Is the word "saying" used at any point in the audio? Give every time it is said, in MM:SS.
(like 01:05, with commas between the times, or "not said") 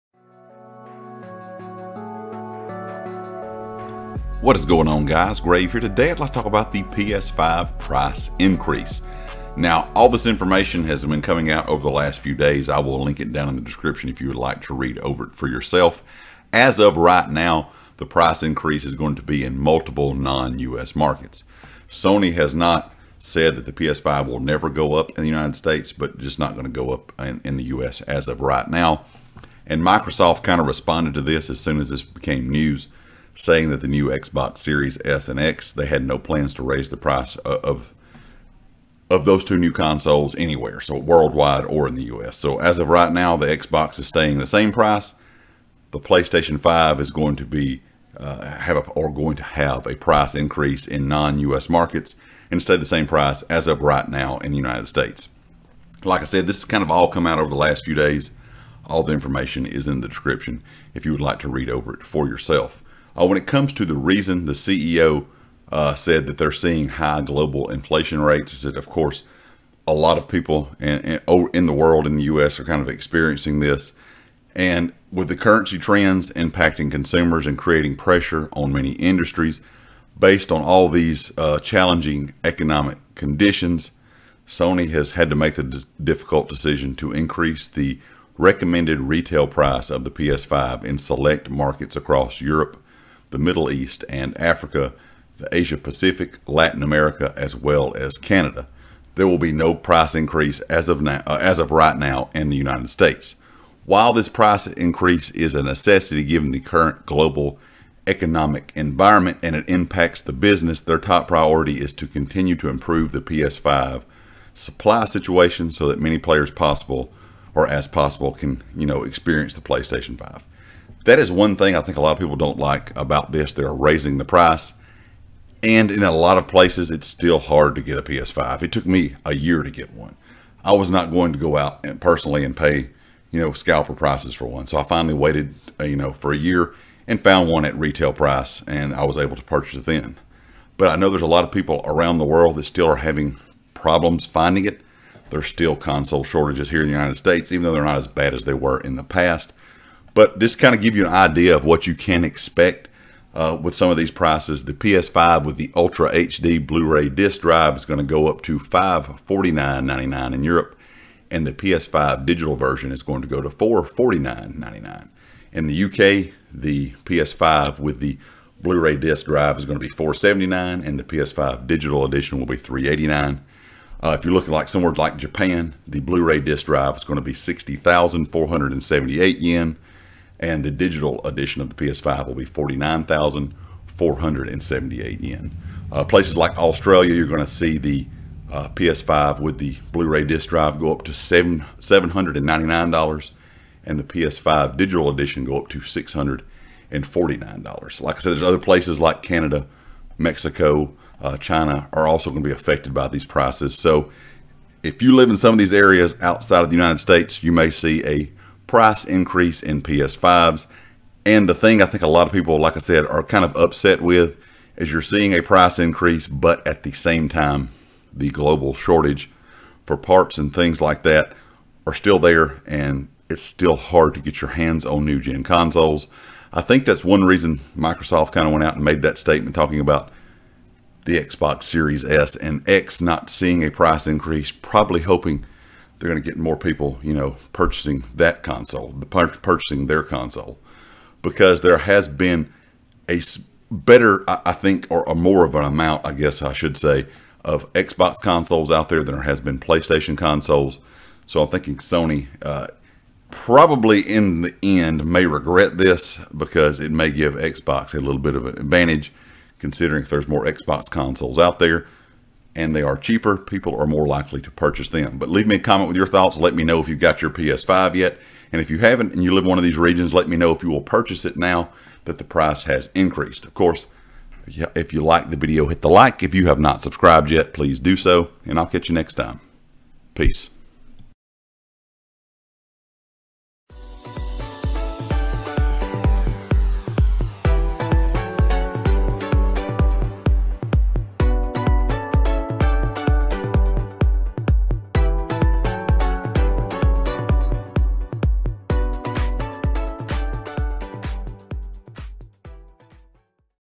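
00:33.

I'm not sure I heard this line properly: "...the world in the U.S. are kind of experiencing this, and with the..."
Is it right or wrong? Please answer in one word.
right.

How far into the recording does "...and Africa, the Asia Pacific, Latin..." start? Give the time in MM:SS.
01:34.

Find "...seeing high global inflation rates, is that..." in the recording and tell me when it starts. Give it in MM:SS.
01:06.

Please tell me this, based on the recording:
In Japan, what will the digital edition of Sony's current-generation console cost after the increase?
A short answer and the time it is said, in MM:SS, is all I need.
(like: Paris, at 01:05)
49,478 yen, at 03:02.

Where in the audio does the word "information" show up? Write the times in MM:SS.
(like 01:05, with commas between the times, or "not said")
00:10, 00:59.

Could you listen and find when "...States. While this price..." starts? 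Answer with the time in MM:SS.
01:42.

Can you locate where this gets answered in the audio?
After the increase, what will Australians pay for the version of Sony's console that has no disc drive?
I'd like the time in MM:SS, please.
03:15.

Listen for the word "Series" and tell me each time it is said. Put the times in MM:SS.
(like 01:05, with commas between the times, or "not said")
00:34, 03:51.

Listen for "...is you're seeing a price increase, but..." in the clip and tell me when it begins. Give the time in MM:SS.
03:34.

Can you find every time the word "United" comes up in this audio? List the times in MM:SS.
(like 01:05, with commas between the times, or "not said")
00:25, 00:54, 01:42, 02:26, 03:26.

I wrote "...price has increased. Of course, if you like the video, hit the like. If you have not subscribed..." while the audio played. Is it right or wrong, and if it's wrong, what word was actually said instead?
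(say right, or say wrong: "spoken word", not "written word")
right.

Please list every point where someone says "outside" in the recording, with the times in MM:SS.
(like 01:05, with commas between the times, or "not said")
03:26.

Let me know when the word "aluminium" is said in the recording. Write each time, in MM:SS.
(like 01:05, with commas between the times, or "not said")
not said.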